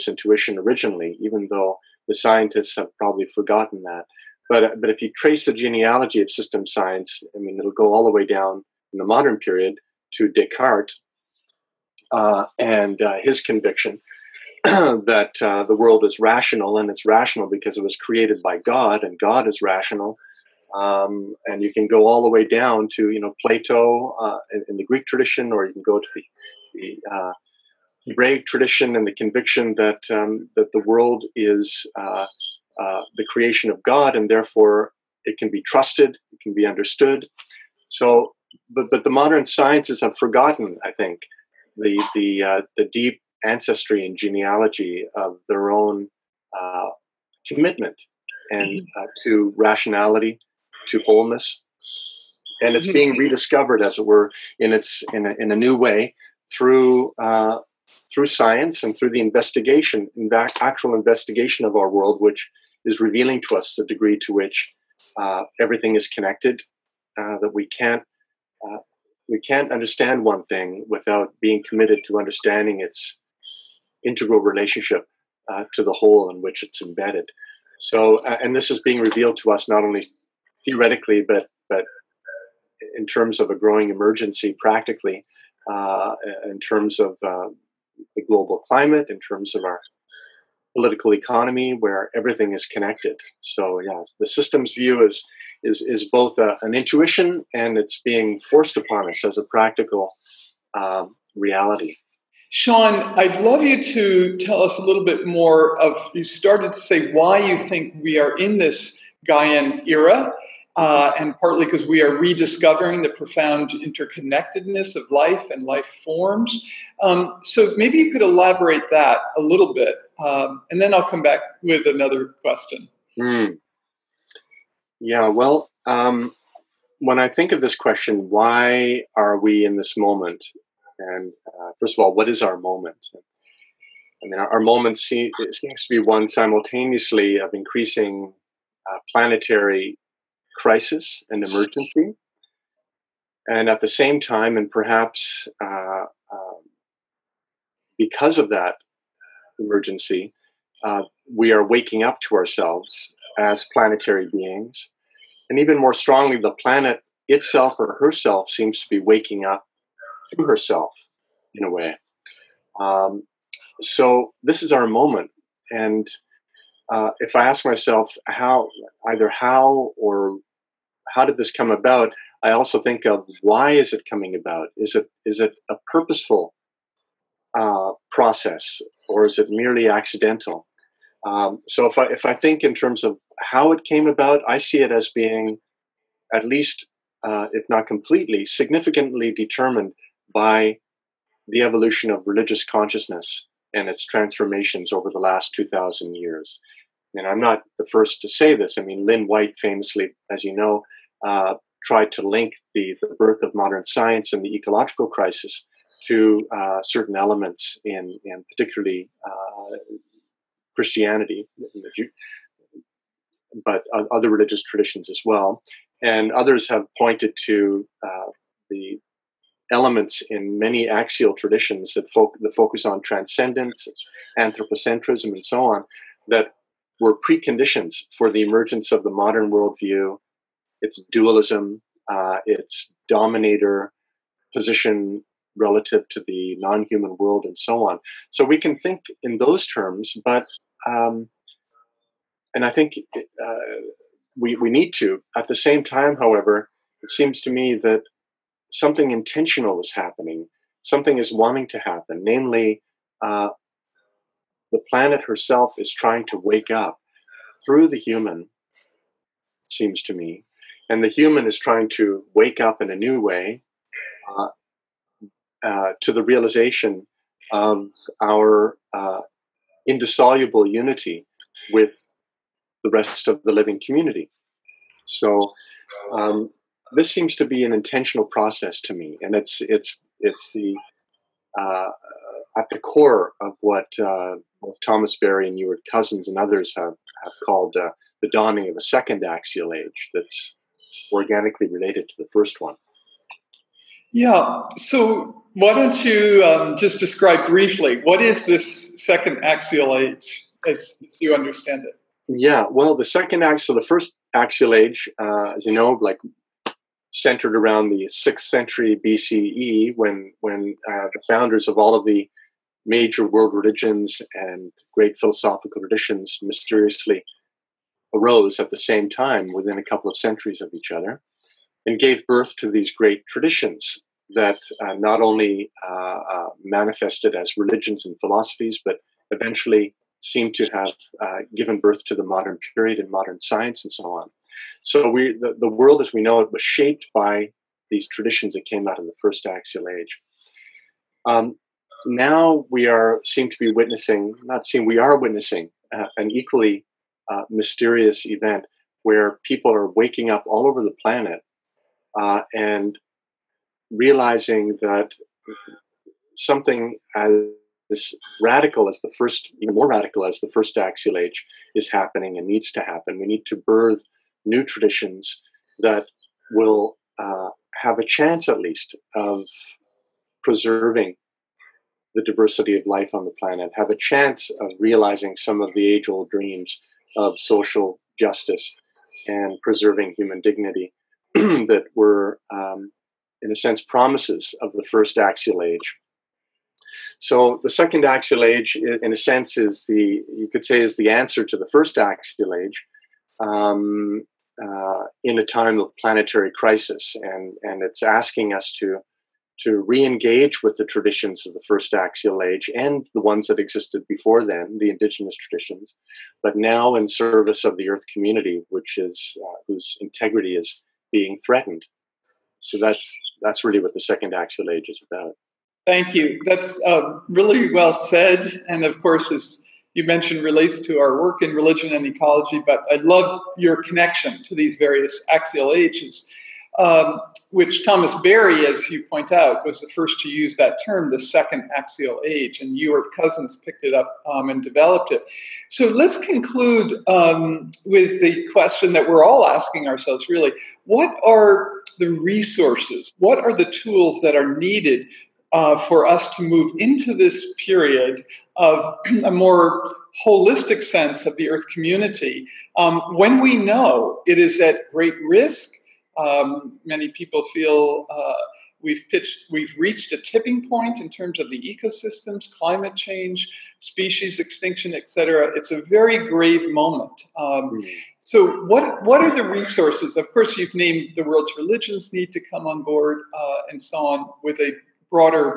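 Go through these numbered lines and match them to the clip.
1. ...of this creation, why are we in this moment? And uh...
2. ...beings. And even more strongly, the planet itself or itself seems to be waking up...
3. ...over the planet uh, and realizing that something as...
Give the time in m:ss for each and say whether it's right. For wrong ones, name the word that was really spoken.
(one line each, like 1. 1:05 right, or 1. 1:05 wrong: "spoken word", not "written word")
1. 2:07 wrong: "question", not "creation"
2. 2:34 wrong: "herself", not "itself"
3. 5:50 right.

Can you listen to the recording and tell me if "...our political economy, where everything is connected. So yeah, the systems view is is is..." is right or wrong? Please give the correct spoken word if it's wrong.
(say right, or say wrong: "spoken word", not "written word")
right.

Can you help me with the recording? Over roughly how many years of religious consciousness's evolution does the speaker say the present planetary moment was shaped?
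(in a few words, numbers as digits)
2,000 years.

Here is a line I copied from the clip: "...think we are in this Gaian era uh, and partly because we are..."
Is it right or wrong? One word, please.
right.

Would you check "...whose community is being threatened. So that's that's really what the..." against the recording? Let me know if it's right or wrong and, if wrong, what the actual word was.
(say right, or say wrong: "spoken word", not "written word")
wrong: "integrity", not "community".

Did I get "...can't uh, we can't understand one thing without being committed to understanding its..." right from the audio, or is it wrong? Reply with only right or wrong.
right.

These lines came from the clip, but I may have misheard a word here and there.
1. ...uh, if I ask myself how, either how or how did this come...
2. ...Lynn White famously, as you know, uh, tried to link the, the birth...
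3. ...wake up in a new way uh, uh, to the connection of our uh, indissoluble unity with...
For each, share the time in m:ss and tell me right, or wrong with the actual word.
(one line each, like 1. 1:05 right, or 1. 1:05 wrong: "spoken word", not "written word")
1. 2:46 right
2. 3:19 right
3. 4:22 wrong: "realization", not "connection".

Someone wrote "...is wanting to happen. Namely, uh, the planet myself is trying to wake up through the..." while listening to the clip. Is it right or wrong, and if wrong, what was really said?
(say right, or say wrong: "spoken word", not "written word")
wrong: "herself", not "myself".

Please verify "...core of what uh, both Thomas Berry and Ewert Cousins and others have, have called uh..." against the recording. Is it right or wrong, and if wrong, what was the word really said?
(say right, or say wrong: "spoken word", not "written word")
right.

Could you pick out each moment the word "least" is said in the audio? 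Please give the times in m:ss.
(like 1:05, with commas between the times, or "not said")
3:06, 6:08.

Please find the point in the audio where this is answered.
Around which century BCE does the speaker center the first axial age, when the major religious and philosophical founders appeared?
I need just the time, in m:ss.
5:08.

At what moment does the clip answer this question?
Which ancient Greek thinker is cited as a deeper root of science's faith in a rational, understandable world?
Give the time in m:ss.
0:23.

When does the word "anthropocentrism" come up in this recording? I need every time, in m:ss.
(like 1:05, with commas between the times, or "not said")
3:44.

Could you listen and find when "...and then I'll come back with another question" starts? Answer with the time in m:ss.
2:00.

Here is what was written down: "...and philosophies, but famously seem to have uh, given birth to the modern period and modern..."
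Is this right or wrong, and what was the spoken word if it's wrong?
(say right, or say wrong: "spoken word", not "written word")
wrong: "eventually", not "famously".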